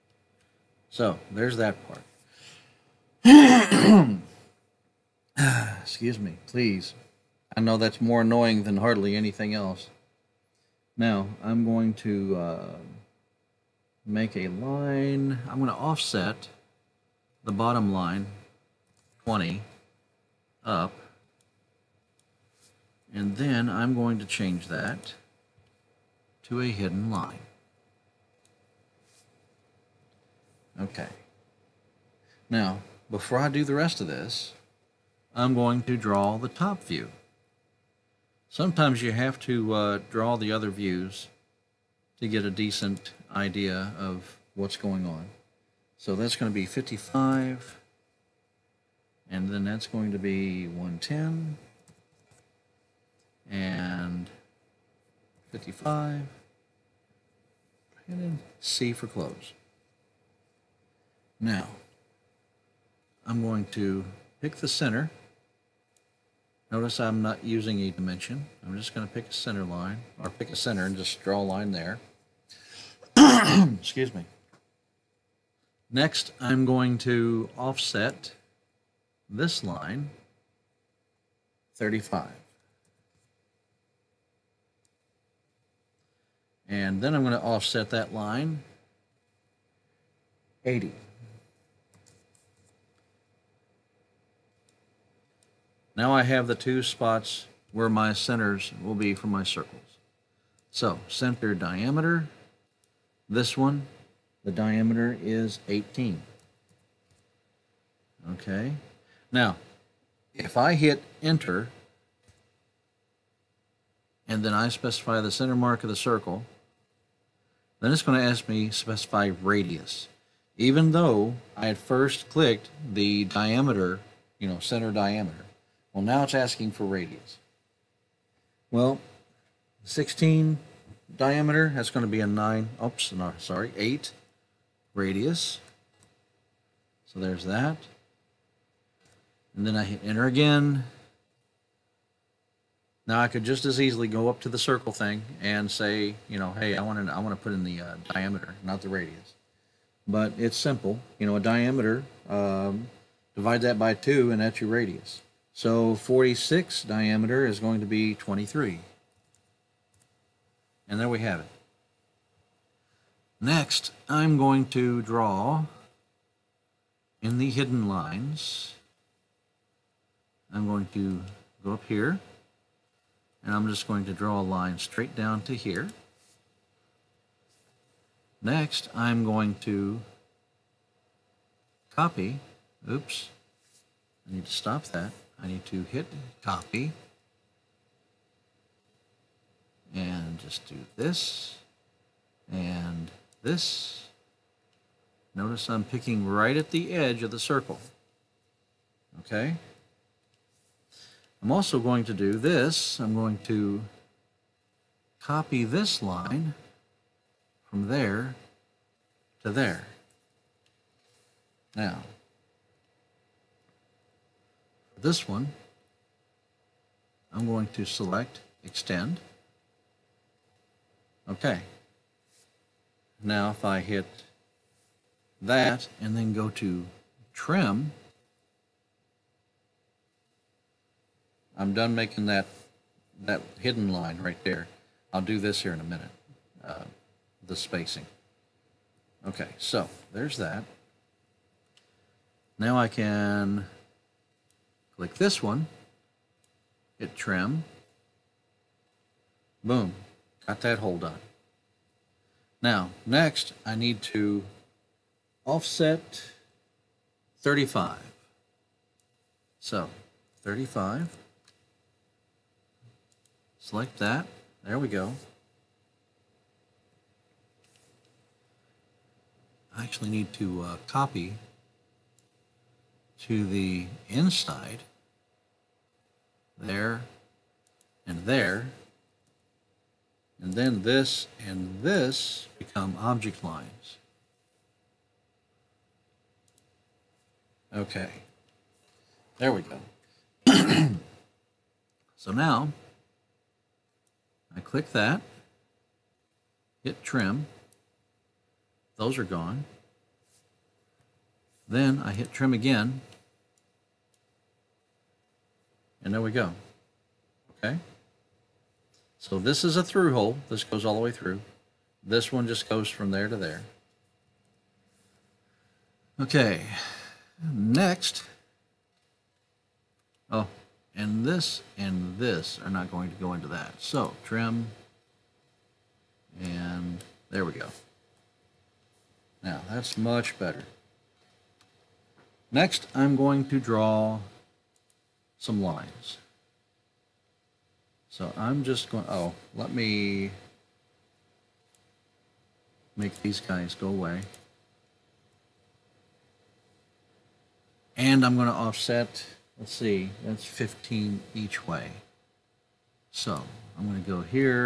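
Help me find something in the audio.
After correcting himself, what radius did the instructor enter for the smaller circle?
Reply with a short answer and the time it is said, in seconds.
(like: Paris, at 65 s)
8, at 133 s.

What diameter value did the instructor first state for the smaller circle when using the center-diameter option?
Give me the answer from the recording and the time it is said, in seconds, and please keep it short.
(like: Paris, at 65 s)
18, at 105 s.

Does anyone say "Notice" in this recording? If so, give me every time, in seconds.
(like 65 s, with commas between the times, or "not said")
66 s, 195 s.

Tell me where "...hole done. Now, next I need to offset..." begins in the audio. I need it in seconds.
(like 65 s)
250 s.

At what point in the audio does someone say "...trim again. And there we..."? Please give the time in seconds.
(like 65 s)
302 s.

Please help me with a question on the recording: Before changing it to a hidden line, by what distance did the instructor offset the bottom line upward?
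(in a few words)
20.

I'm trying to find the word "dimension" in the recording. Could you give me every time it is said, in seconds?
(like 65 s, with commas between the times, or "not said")
67 s.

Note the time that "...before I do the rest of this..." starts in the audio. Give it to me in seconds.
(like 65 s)
33 s.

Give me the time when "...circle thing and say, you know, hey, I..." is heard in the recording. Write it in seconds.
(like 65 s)
144 s.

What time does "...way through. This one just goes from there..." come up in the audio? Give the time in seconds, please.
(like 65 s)
311 s.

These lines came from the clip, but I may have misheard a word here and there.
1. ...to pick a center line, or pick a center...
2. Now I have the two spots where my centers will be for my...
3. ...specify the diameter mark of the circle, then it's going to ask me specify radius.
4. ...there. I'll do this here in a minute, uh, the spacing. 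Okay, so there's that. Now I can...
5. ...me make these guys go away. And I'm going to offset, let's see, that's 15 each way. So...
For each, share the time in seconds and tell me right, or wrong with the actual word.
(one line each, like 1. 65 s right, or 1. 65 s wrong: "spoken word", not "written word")
1. 69 s right
2. 95 s right
3. 114 s wrong: "center", not "diameter"
4. 234 s right
5. 339 s right.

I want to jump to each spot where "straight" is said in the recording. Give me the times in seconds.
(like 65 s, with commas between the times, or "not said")
174 s.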